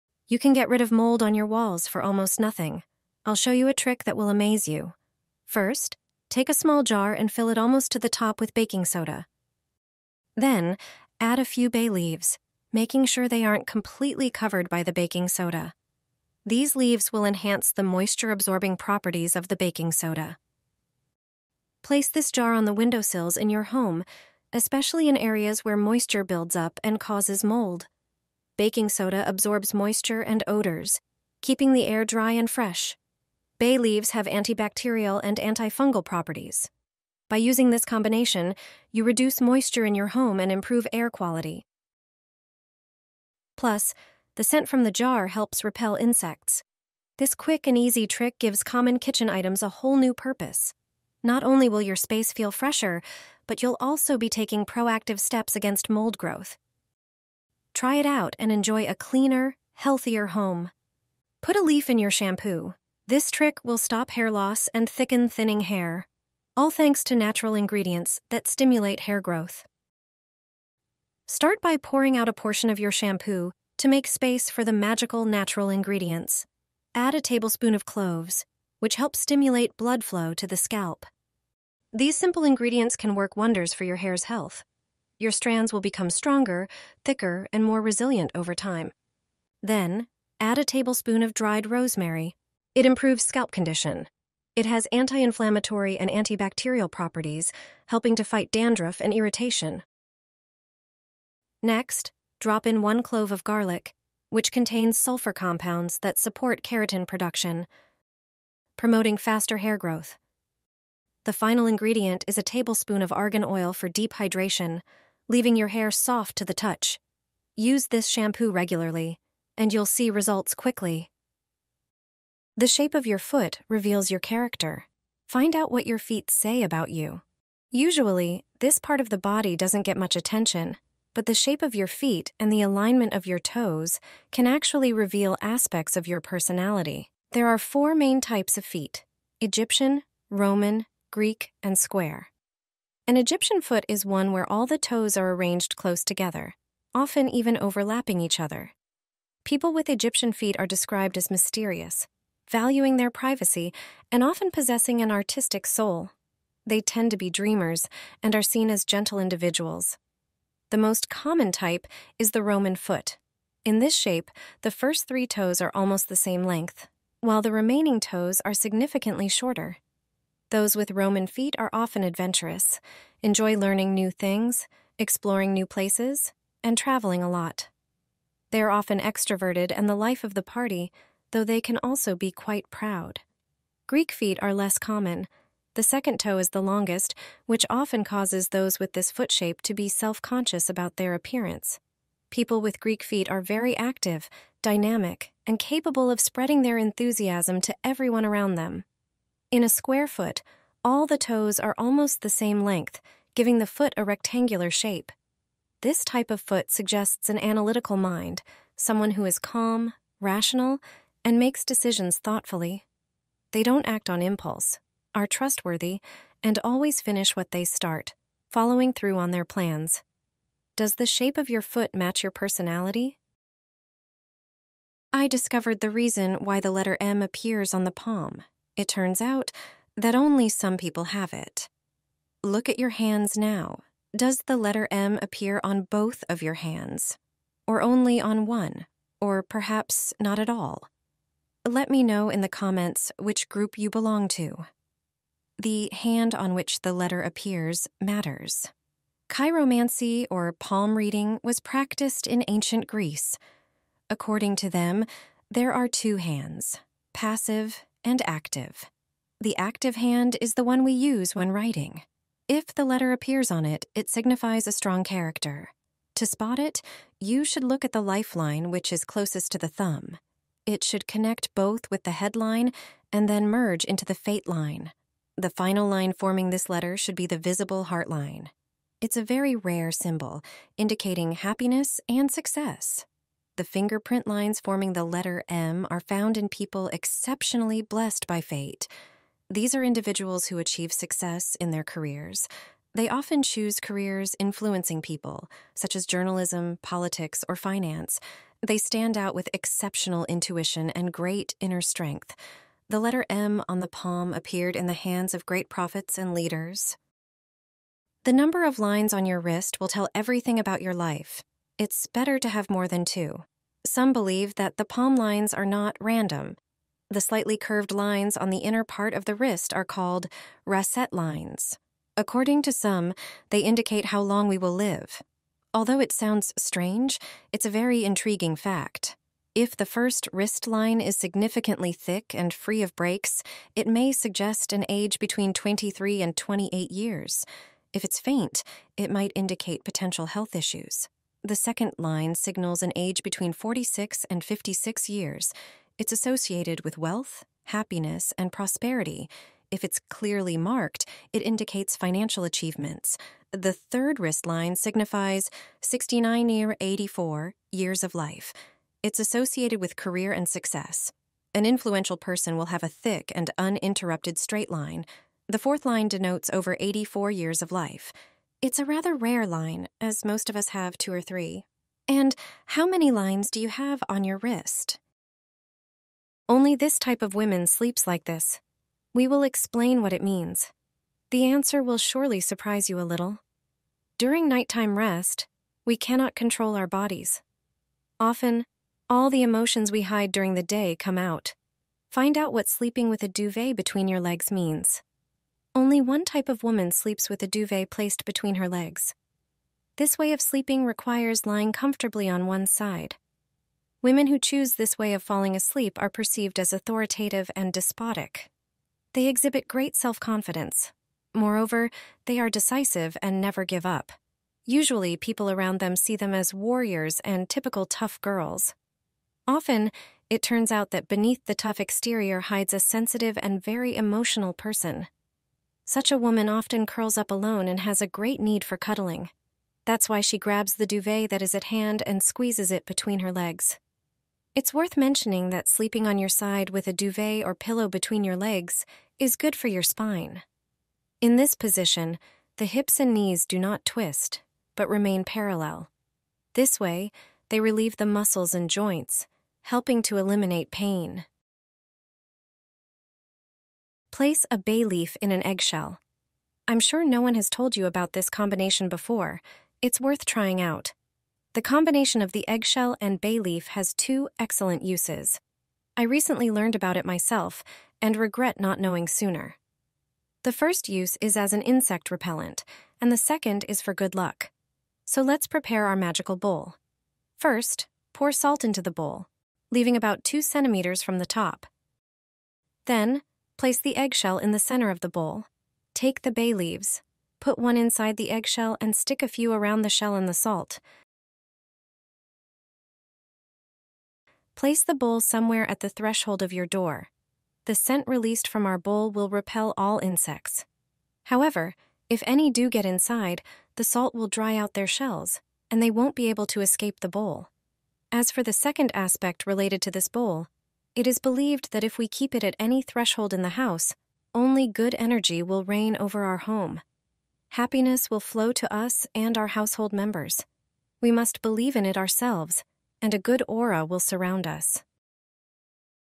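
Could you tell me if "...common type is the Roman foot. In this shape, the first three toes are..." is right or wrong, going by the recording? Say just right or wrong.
right.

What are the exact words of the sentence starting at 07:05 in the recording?
Such a woman often curls up alone and has a great need for cuddling.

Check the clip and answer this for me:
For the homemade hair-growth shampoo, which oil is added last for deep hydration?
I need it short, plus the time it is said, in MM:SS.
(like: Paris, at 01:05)
argan oil, at 01:53.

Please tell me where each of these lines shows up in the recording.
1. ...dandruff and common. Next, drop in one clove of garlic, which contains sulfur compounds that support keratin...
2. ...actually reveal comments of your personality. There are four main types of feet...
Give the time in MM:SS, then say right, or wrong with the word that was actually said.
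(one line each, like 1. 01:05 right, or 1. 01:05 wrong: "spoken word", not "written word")
1. 01:38 wrong: "irritation", not "common"
2. 02:14 wrong: "aspects", not "comments".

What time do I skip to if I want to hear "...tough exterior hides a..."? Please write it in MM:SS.
07:01.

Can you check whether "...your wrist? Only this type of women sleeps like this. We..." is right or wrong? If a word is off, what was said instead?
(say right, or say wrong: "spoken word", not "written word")
right.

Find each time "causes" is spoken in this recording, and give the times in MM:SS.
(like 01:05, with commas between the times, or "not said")
00:27, 03:08.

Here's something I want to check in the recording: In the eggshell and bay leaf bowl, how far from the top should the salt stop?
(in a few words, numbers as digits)
2 centimeters.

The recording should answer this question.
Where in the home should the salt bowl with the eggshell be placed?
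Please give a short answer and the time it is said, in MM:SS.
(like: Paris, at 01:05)
threshold of your door, at 08:15.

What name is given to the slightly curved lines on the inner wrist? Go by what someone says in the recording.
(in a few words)
rascette lines.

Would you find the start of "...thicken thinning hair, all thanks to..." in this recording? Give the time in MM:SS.
01:04.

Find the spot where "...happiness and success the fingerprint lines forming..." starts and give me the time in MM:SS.
04:41.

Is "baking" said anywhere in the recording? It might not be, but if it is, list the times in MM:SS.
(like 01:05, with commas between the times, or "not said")
00:08, 00:14, 00:19, 00:28.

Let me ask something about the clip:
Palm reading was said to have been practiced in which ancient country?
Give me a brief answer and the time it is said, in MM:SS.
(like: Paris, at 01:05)
Greece, at 04:12.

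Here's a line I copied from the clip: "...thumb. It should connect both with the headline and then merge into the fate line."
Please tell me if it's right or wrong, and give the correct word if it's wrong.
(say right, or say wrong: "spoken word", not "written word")
right.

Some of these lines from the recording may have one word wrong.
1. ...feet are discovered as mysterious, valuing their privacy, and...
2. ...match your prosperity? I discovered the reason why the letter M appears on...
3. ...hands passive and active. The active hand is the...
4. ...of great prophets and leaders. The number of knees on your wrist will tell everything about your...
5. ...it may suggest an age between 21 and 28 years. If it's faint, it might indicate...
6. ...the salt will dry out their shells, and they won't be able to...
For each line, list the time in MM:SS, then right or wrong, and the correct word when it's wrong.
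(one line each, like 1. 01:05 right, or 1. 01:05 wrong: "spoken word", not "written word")
1. 02:30 wrong: "described", not "discovered"
2. 03:41 wrong: "personality", not "prosperity"
3. 04:16 right
4. 05:05 wrong: "lines", not "knees"
5. 05:33 wrong: "23", not "21"
6. 08:23 right.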